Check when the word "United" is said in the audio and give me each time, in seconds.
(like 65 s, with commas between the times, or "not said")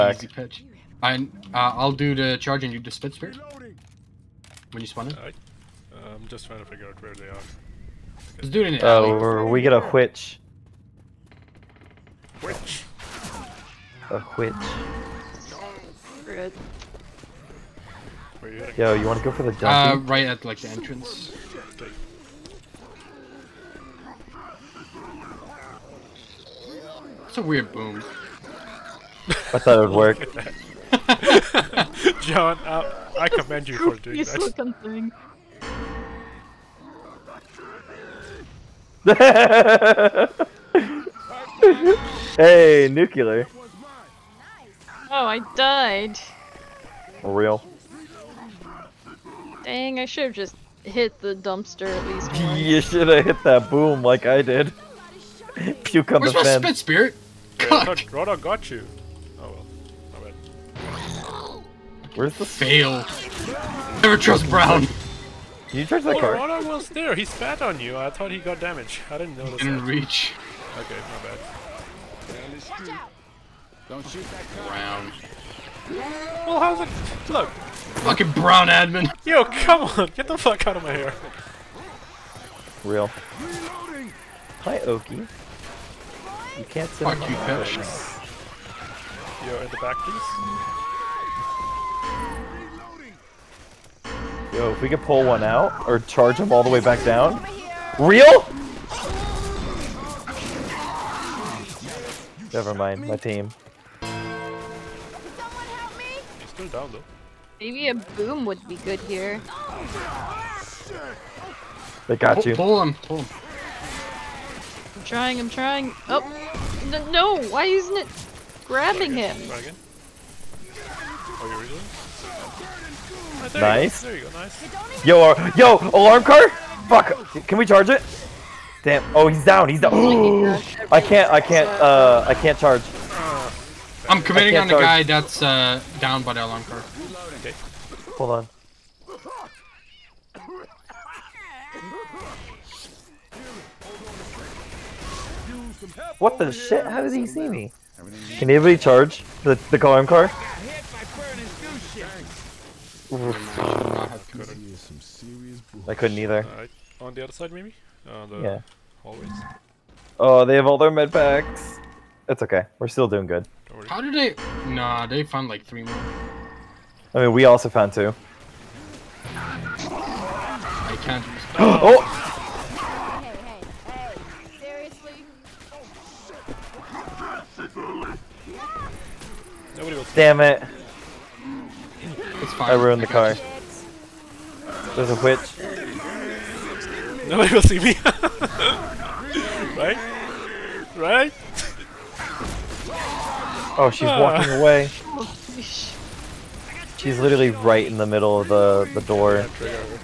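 not said.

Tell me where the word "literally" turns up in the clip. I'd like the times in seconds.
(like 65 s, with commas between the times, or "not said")
197 s.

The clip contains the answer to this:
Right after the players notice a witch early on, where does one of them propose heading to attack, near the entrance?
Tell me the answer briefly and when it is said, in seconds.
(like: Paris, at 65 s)
the dungeon, at 19 s.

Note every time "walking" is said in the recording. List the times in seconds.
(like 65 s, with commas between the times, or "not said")
194 s.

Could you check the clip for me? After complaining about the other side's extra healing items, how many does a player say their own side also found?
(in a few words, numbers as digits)
2.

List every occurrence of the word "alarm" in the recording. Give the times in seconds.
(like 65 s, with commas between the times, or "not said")
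125 s, 136 s.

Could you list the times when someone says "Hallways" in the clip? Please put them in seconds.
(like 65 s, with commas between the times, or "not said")
159 s.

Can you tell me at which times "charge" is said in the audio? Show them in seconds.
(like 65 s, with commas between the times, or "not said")
2 s, 65 s, 95 s, 127 s, 132 s, 148 s.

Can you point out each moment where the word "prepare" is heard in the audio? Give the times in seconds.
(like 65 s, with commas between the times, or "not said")
not said.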